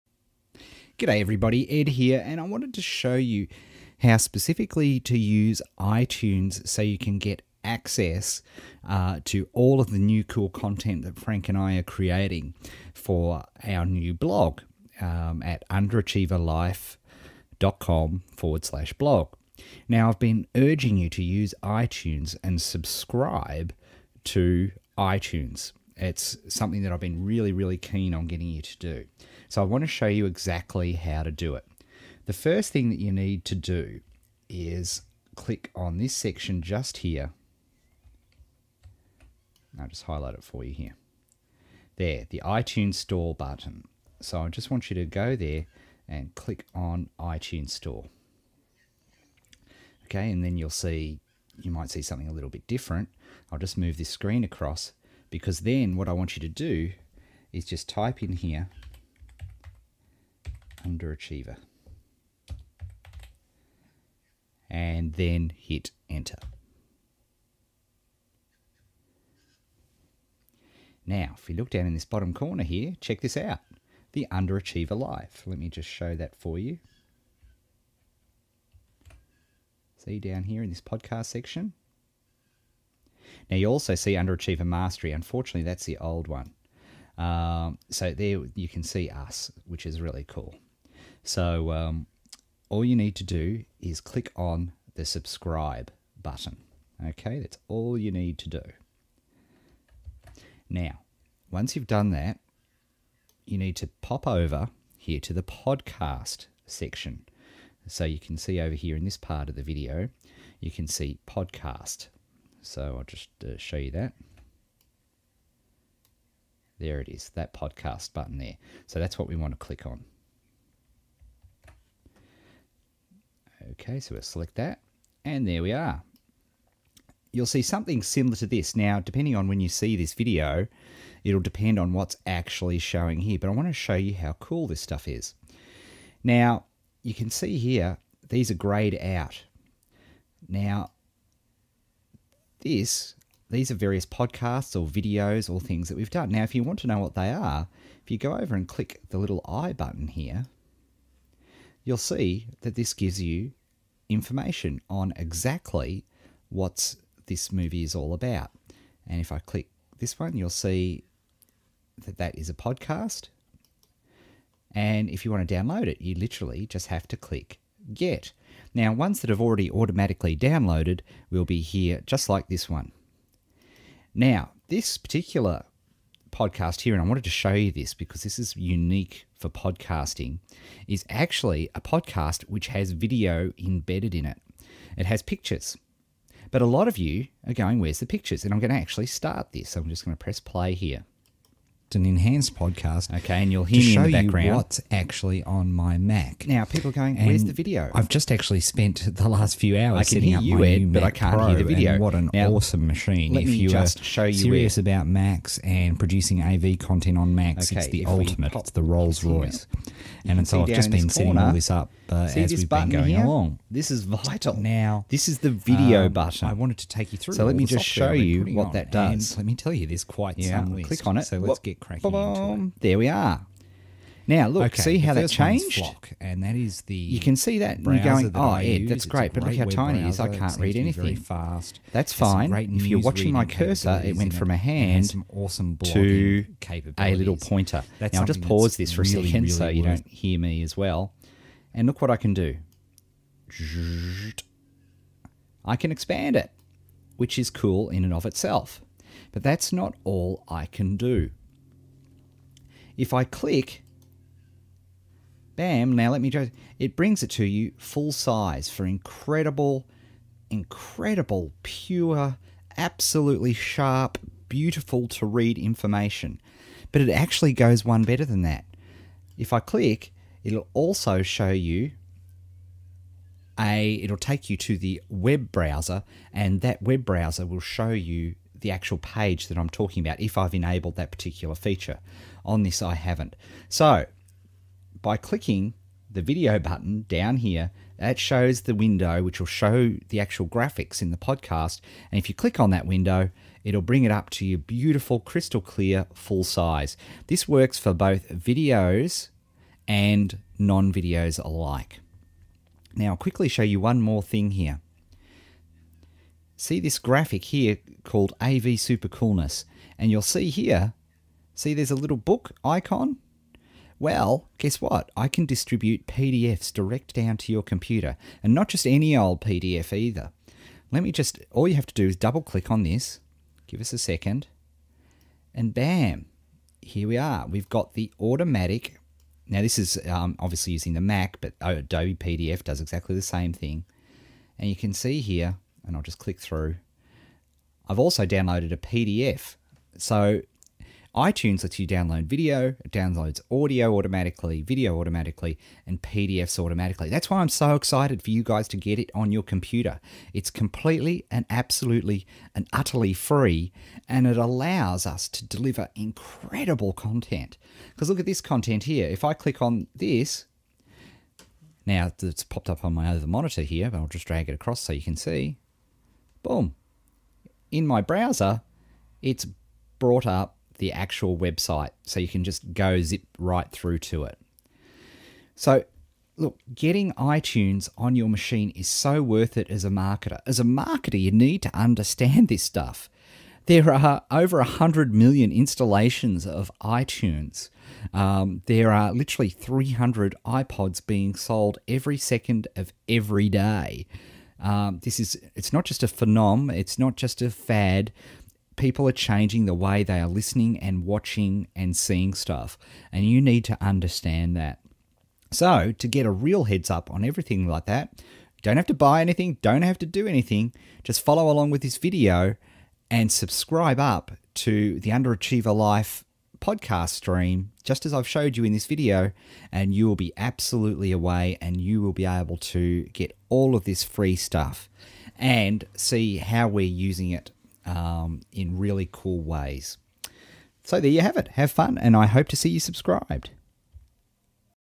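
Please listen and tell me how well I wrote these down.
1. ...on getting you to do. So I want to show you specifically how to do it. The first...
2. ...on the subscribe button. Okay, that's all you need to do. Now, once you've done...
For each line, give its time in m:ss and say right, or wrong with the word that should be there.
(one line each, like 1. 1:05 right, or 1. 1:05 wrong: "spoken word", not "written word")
1. 0:28 wrong: "exactly", not "specifically"
2. 1:34 right.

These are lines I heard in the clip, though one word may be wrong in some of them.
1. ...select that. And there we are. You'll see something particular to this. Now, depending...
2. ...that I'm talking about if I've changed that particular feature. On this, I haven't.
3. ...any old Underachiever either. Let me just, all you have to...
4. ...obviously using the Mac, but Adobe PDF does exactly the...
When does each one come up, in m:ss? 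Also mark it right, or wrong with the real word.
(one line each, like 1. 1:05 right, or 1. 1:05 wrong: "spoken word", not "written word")
1. 2:04 wrong: "similar", not "particular"
2. 4:39 wrong: "enabled", not "changed"
3. 5:18 wrong: "PDF", not "Underachiever"
4. 5:30 right.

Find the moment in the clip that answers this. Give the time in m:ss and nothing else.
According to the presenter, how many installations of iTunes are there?
6:24.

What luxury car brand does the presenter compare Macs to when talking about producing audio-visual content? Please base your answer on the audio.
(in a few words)
Rolls Royce.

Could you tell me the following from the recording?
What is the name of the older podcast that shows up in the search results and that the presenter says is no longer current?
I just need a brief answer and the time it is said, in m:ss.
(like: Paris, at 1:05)
Underachiever Mastery, at 1:24.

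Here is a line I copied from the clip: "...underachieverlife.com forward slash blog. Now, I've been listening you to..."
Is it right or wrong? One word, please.
wrong.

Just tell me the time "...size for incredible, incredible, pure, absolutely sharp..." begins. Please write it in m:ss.
4:18.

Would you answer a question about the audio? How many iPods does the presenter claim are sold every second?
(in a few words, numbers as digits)
300.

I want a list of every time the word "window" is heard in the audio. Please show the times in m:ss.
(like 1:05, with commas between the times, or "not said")
4:48, 4:52.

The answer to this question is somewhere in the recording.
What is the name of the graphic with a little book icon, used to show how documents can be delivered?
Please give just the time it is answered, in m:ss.
5:08.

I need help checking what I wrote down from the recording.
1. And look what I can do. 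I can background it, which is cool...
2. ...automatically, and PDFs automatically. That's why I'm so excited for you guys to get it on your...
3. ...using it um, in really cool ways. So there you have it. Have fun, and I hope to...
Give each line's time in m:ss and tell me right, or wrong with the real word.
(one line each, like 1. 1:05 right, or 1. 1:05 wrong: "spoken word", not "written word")
1. 4:01 wrong: "expand", not "background"
2. 5:44 right
3. 7:06 right.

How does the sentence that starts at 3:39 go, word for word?
let me tell you, there's quite some.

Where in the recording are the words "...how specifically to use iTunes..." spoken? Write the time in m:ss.
0:04.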